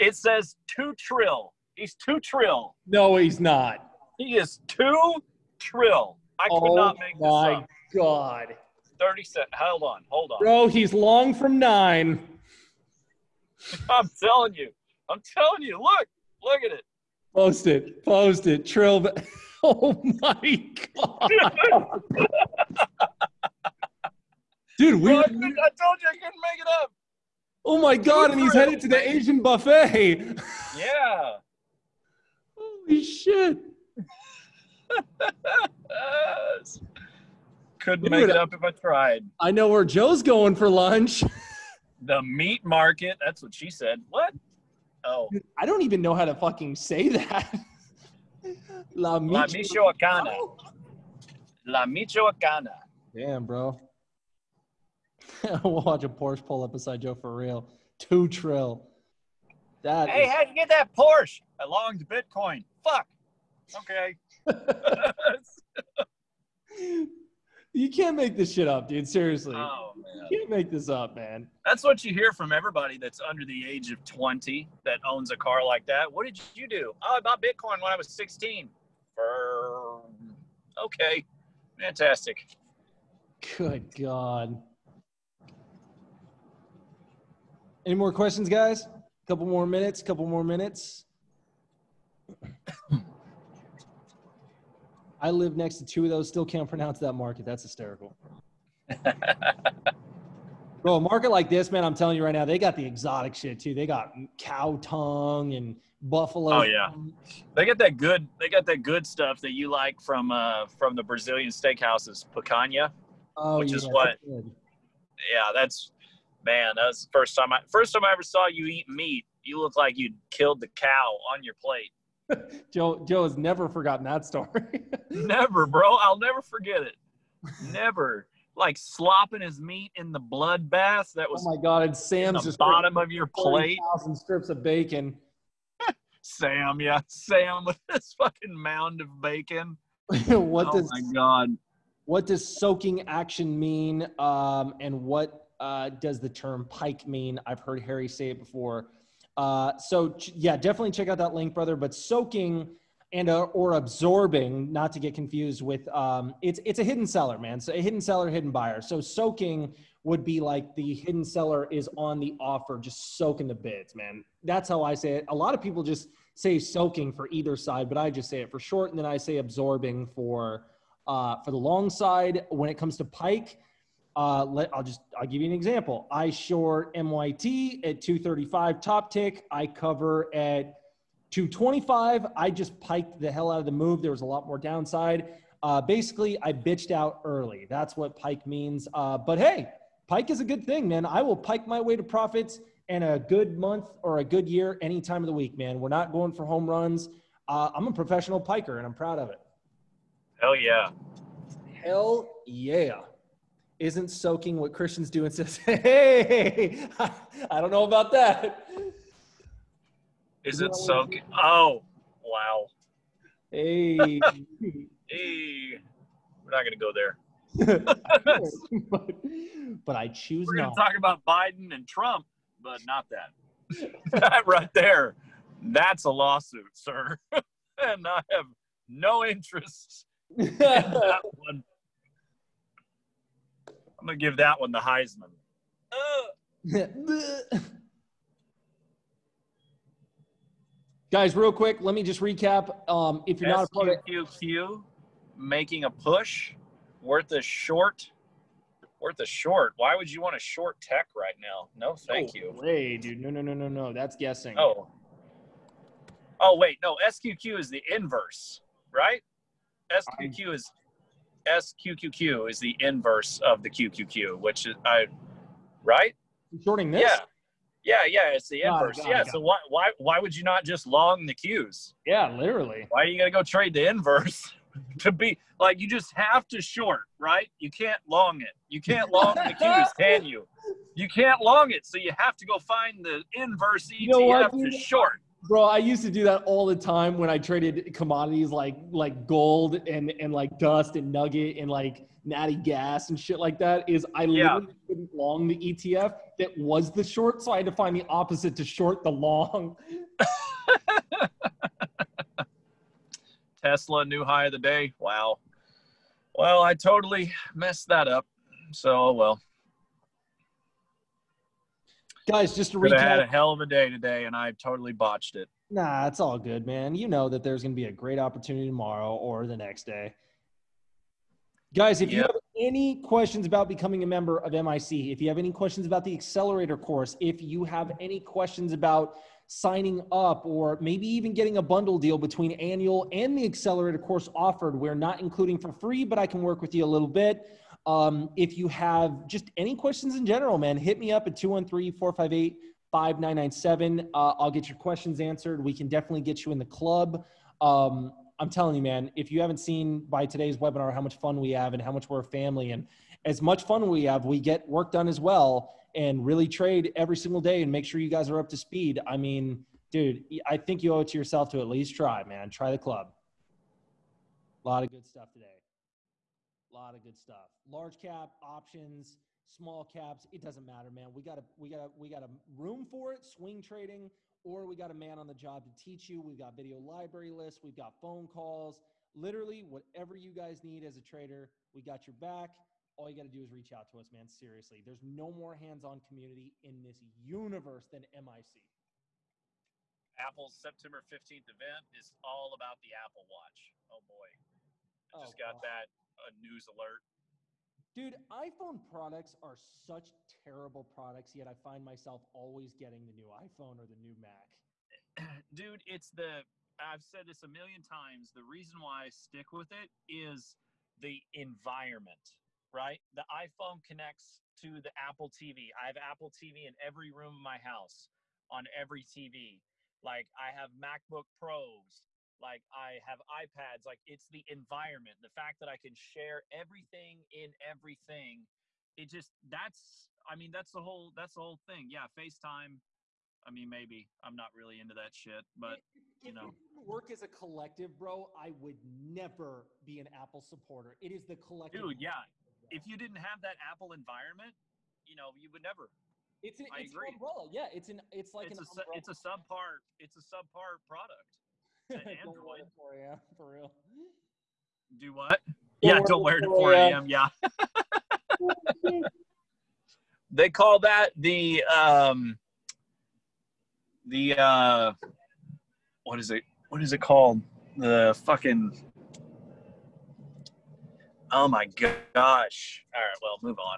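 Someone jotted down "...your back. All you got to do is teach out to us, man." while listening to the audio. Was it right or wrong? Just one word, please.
wrong.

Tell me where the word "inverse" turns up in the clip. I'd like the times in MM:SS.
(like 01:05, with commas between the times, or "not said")
04:17, 04:22, 04:28, 04:33, 04:43.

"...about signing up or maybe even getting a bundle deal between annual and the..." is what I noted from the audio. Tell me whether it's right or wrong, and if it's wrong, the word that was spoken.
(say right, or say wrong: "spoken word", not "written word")
right.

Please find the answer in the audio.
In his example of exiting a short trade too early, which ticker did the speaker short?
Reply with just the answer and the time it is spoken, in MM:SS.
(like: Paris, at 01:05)
MYT, at 02:56.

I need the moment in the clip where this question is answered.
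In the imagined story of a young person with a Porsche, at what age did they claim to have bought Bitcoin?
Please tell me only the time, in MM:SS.
01:18.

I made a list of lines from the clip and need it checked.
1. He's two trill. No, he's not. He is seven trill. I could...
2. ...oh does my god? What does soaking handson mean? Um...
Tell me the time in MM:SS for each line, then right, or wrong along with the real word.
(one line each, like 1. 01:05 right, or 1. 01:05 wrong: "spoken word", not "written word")
1. 00:01 wrong: "two", not "seven"
2. 02:20 wrong: "action", not "handson".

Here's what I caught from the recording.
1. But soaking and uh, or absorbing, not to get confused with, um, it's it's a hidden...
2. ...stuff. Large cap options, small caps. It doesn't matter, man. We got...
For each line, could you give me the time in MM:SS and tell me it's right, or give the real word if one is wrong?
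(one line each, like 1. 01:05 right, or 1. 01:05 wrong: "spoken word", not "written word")
1. 02:31 right
2. 06:07 right.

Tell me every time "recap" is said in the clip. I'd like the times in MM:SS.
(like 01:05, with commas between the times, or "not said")
04:02, 05:12.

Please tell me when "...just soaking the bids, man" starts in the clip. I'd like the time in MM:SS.
02:42.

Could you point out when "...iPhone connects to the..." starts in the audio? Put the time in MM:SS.
06:53.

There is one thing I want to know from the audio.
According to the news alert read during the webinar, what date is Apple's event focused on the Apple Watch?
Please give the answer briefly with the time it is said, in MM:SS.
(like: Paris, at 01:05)
September 15th, at 06:30.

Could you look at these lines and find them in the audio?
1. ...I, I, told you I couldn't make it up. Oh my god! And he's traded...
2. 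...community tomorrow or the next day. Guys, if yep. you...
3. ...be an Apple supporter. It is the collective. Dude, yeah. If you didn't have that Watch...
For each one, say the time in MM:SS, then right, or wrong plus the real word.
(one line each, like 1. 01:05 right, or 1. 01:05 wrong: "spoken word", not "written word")
1. 00:25 wrong: "headed", not "traded"
2. 05:18 wrong: "opportunity", not "community"
3. 07:19 wrong: "Apple", not "Watch".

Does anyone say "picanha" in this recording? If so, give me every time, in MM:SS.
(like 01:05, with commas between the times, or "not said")
01:52.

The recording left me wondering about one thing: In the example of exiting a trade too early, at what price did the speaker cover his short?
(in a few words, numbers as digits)
225.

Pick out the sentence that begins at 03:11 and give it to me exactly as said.
I will pike my way to profits and a good month or a good year any time of the week, man.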